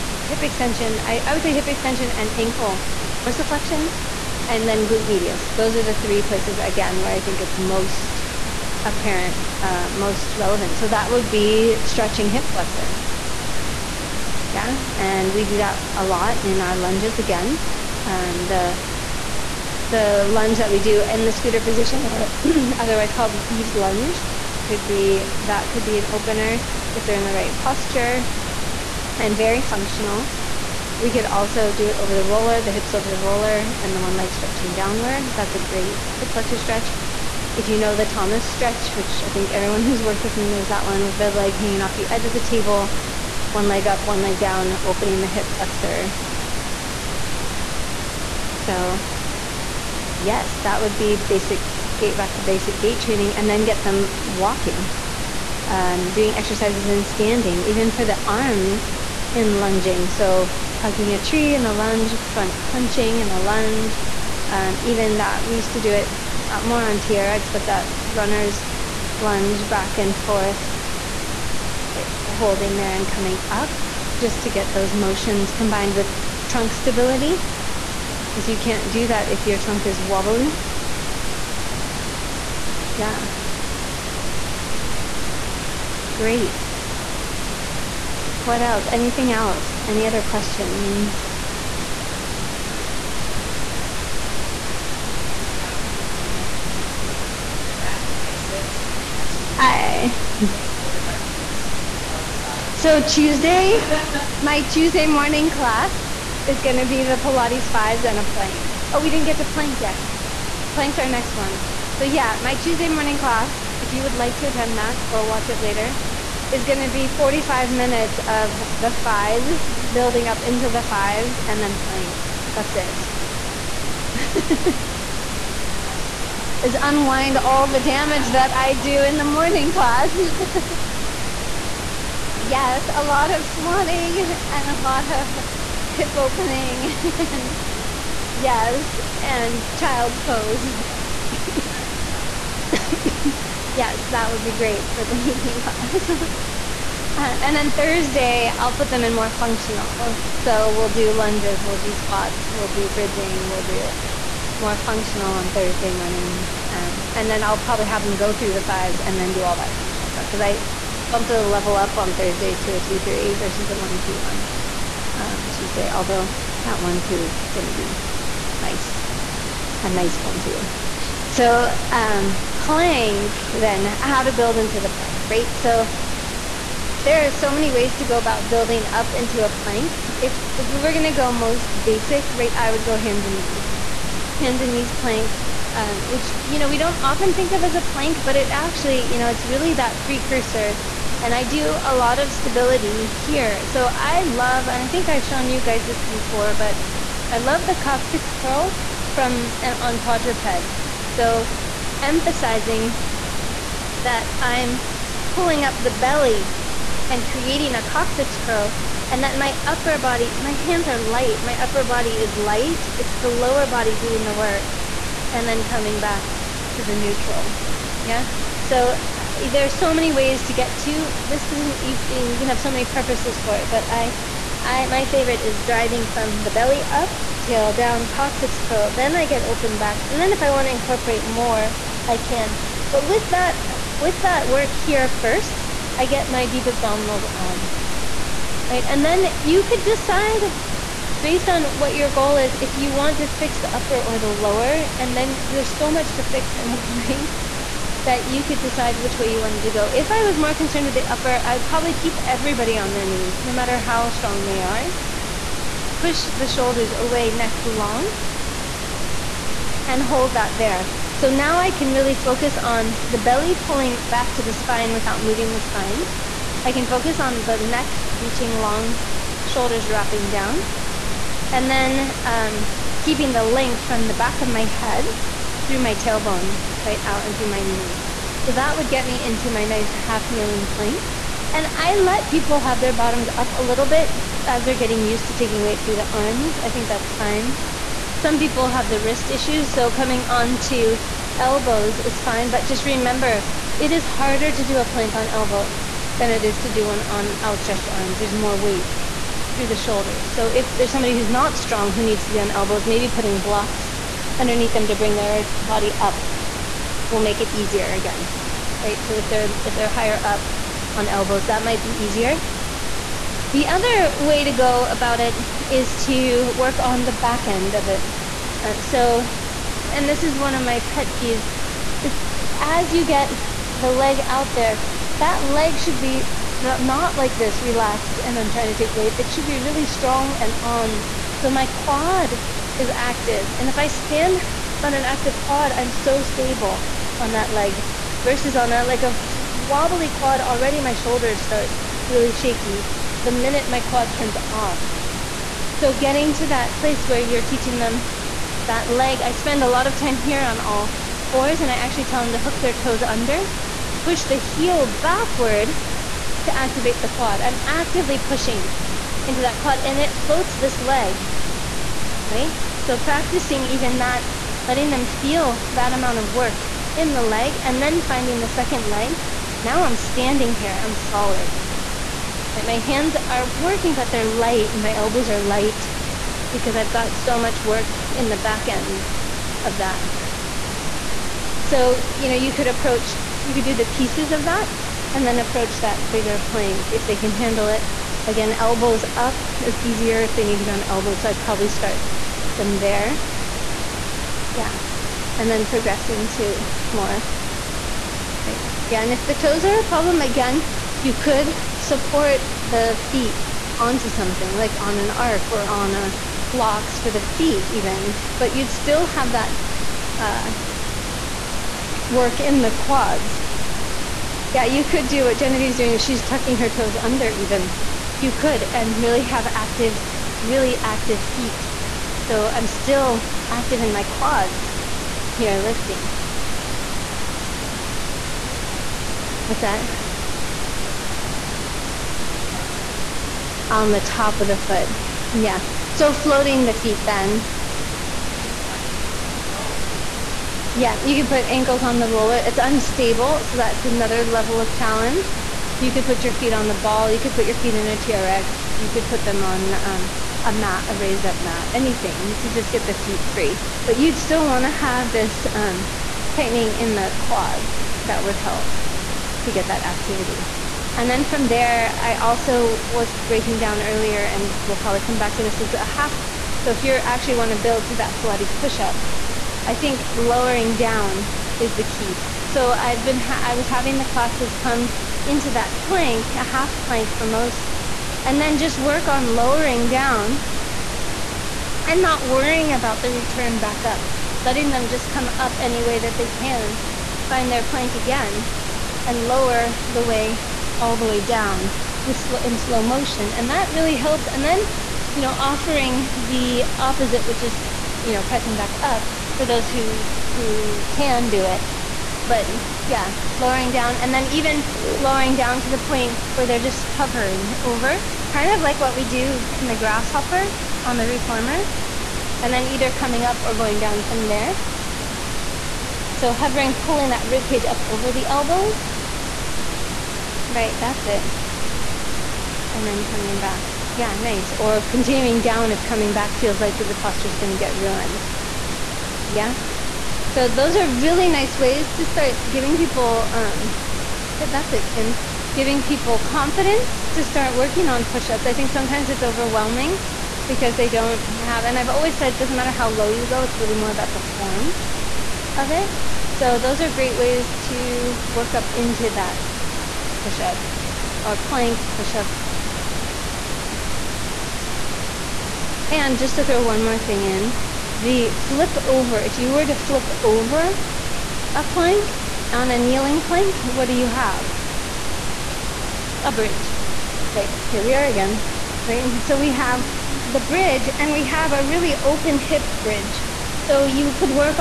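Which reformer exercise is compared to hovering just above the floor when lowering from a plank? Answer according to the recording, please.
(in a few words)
Grasshopper.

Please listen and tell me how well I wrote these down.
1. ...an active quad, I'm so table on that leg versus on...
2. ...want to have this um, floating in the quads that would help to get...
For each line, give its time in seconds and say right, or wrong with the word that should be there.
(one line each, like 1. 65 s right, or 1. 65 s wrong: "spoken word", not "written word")
1. 334 s wrong: "stable", not "table"
2. 454 s wrong: "tightening", not "floating".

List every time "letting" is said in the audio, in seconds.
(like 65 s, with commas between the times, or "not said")
364 s, 484 s.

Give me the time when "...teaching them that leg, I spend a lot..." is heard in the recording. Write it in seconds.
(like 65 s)
347 s.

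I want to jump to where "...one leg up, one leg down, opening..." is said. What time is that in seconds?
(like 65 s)
43 s.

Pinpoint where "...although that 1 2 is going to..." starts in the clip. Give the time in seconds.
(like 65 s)
165 s.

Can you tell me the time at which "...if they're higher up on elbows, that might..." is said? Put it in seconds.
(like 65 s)
309 s.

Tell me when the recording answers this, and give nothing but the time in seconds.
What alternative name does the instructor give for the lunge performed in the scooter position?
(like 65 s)
23 s.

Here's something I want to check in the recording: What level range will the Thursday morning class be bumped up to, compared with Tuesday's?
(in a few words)
2 3.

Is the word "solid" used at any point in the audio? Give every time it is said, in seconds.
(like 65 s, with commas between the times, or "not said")
370 s.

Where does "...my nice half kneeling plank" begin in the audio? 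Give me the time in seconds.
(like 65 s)
279 s.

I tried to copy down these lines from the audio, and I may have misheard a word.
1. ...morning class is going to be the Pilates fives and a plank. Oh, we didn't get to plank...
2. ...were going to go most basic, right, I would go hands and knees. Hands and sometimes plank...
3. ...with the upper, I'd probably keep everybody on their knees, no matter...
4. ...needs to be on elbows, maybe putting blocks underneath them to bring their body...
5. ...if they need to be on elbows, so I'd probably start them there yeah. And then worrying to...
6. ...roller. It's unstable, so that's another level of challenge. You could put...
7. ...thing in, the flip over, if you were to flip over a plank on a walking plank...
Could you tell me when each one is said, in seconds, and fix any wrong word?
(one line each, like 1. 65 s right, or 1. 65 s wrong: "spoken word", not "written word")
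1. 105 s right
2. 180 s wrong: "knees", not "sometimes"
3. 250 s right
4. 302 s right
5. 390 s wrong: "progressing", not "worrying"
6. 442 s right
7. 556 s wrong: "kneeling", not "walking".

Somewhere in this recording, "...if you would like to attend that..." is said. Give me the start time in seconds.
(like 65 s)
113 s.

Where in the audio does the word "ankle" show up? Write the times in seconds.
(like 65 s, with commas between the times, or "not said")
2 s, 441 s.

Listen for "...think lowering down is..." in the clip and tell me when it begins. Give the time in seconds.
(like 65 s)
469 s.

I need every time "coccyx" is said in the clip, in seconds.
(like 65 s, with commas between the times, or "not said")
197 s, 207 s, 228 s.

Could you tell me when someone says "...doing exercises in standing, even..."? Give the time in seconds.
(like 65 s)
56 s.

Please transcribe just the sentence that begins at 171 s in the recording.
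So, um, plank, then, how to build into the plank, right?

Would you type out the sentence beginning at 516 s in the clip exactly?
So hovering, pulling that rib cage up over the elbows.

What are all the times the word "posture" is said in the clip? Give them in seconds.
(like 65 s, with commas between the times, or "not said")
27 s, 526 s.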